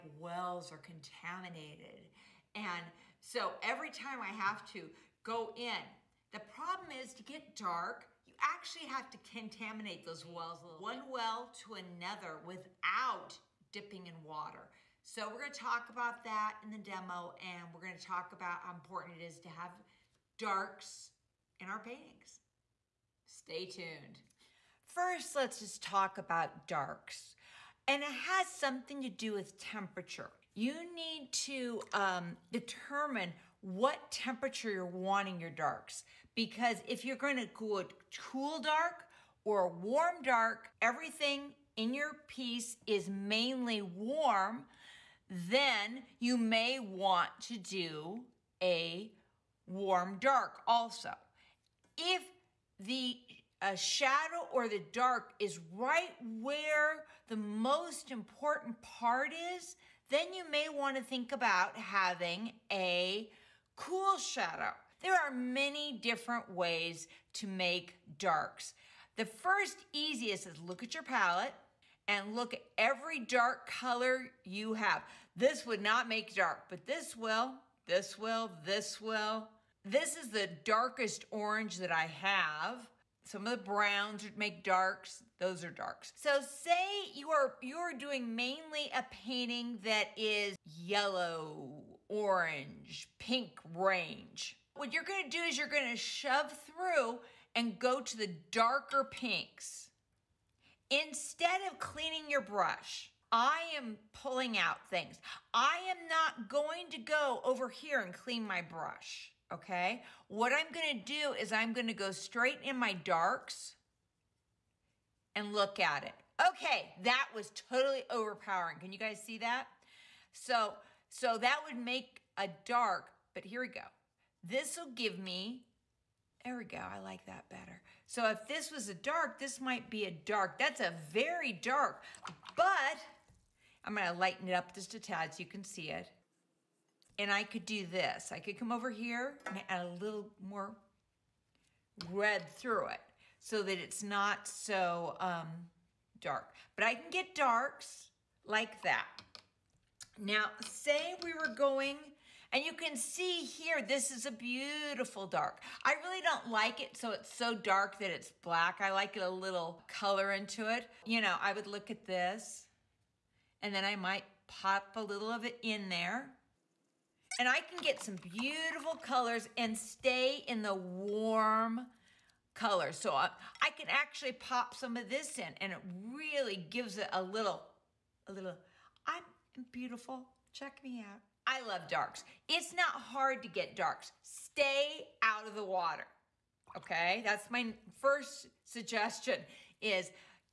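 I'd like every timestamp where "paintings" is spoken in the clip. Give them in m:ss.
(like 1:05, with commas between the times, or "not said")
0:21, 1:29.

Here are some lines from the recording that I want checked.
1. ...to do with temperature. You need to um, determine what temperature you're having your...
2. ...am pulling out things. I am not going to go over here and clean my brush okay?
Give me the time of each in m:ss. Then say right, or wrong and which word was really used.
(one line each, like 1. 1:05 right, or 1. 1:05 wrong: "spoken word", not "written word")
1. 0:29 wrong: "wanting", not "having"
2. 1:43 right.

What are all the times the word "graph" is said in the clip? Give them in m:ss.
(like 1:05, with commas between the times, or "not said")
not said.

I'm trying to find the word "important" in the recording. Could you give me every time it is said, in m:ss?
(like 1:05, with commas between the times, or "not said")
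0:18, 0:58.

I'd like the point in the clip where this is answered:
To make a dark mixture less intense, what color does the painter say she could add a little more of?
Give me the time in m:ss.
2:22.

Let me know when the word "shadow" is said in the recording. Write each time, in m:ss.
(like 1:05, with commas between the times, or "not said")
0:53, 1:04.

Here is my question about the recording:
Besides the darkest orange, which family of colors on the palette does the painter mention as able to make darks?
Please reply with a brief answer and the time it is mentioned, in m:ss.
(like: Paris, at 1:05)
Browns, at 1:23.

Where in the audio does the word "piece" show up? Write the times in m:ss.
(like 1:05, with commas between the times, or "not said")
0:42.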